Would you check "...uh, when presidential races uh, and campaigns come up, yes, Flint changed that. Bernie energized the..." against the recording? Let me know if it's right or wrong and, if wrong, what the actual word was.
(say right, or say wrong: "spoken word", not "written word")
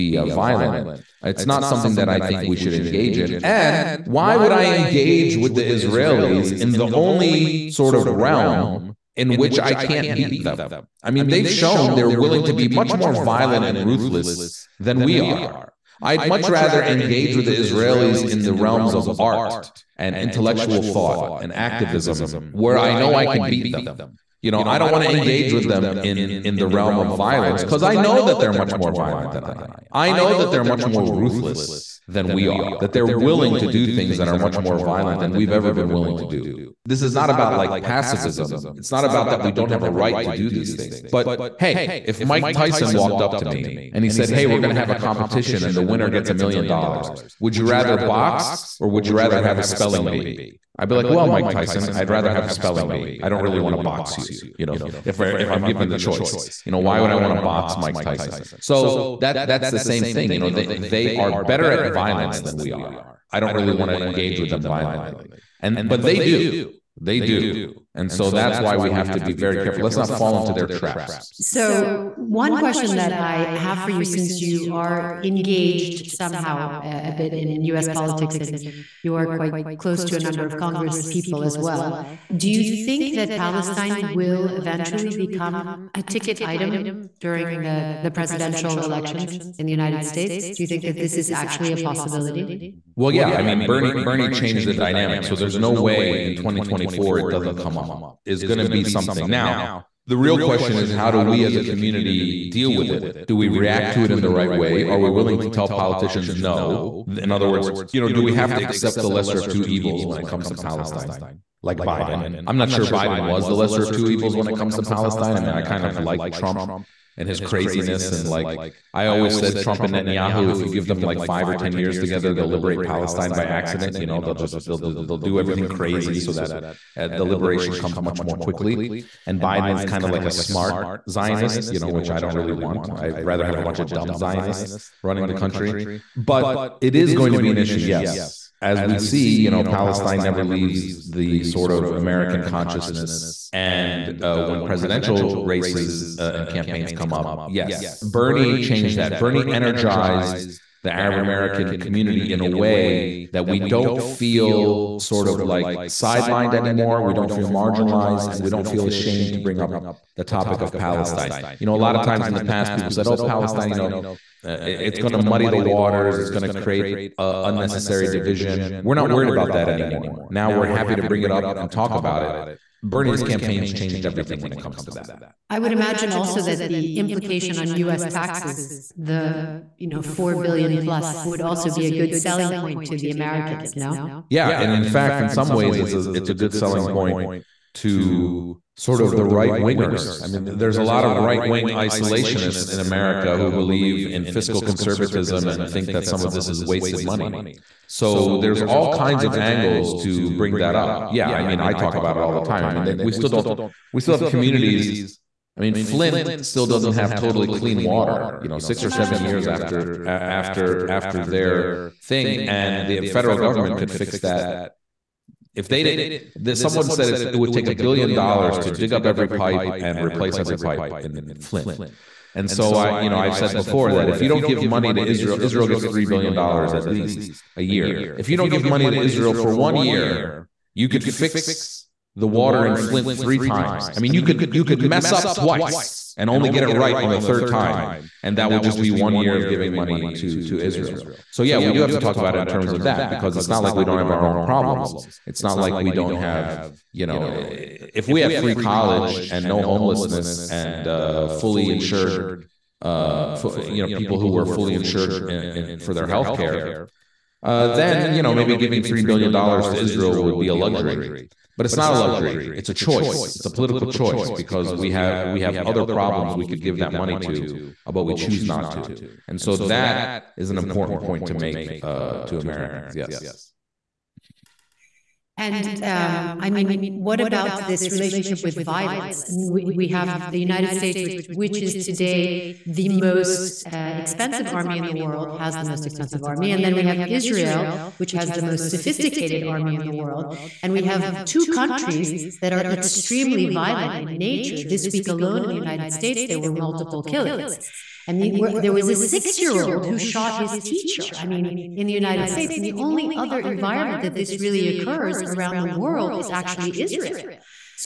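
wrong: "Bernie", not "Flint".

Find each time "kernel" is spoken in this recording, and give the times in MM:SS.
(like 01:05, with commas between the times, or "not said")
not said.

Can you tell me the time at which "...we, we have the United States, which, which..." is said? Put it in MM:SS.
04:39.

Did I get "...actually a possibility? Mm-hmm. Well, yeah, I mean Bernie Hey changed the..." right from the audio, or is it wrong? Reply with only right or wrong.
wrong.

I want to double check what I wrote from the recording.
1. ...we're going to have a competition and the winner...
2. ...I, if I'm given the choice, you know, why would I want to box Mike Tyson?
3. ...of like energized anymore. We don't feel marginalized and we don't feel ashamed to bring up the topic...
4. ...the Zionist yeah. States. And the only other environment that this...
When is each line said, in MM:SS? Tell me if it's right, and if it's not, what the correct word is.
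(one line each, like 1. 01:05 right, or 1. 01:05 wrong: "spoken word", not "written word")
1. 00:44 right
2. 00:55 right
3. 02:35 wrong: "sidelined", not "energized"
4. 05:01 wrong: "United", not "Zionist".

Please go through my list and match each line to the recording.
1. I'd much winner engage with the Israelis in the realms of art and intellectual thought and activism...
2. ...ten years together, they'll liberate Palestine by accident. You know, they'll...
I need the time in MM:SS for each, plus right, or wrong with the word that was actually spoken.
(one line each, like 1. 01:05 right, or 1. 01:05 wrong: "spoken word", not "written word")
1. 00:16 wrong: "rather", not "winner"
2. 02:01 right.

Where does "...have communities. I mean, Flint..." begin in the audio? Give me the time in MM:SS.
03:24.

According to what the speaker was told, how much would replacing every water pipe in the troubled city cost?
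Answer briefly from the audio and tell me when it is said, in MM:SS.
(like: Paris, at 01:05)
1 billion dollars, at 03:37.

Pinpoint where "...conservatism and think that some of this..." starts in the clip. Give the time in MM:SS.
03:14.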